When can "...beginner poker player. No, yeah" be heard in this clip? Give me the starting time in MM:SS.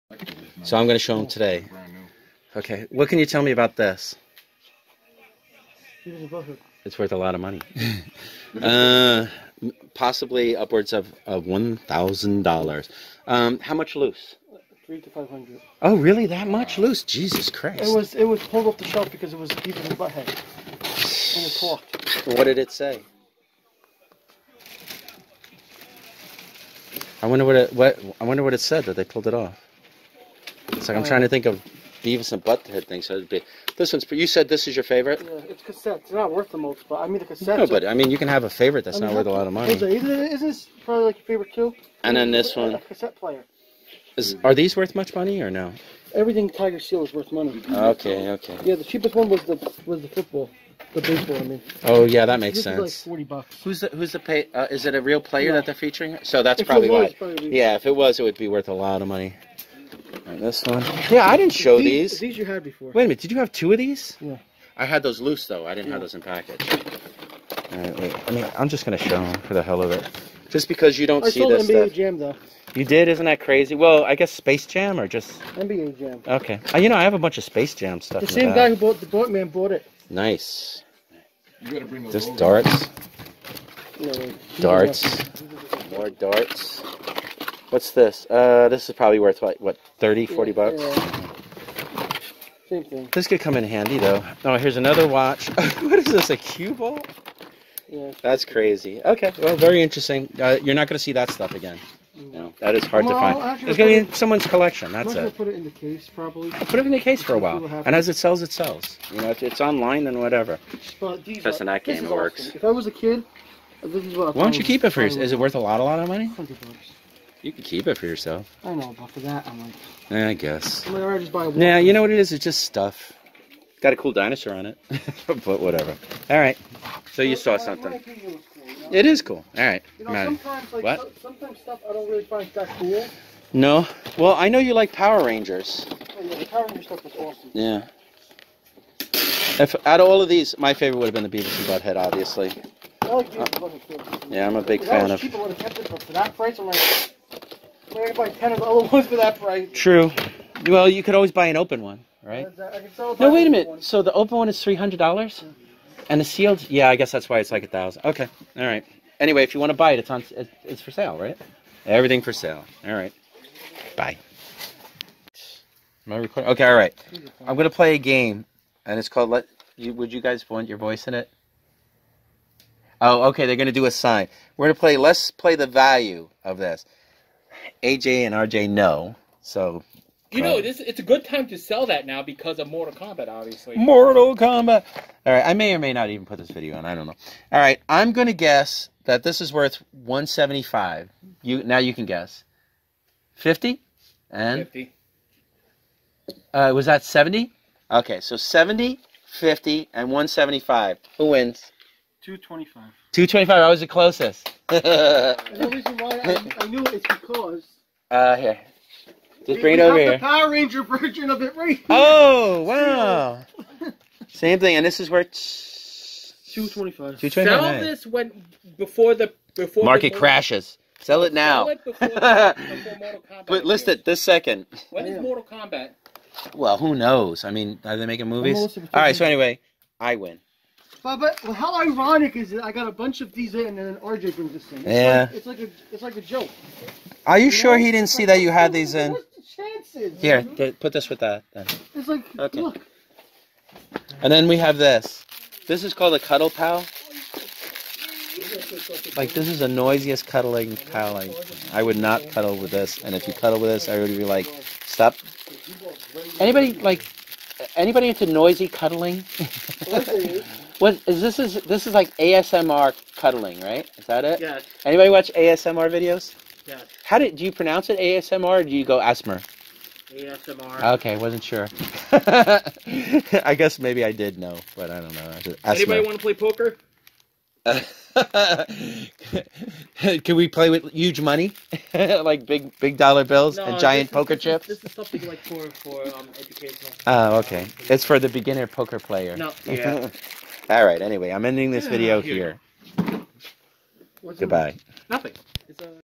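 04:48.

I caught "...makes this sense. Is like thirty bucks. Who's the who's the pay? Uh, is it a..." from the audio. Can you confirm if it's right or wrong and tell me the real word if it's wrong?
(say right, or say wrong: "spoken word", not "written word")
wrong: "forty", not "thirty".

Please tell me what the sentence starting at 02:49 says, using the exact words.
You, would you guys want your voice in it?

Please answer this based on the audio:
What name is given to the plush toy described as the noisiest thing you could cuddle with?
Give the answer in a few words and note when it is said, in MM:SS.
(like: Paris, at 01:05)
cuddle pal, at 04:06.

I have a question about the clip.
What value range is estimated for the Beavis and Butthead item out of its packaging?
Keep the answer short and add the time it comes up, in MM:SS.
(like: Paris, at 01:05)
$300 to $500, at 00:14.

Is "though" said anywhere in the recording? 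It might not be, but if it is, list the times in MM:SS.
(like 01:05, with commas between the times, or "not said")
01:05, 01:12, 01:33.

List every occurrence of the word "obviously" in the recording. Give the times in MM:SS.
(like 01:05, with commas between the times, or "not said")
02:21, 03:03.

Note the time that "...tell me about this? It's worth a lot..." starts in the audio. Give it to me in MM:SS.
00:03.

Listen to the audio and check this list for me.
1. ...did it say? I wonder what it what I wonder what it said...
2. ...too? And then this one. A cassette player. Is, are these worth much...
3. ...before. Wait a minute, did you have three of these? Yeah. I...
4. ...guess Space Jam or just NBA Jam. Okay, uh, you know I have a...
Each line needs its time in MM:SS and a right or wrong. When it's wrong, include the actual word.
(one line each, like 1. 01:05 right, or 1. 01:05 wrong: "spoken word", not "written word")
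1. 00:22 right
2. 00:41 right
3. 01:02 wrong: "two", not "three"
4. 01:14 right.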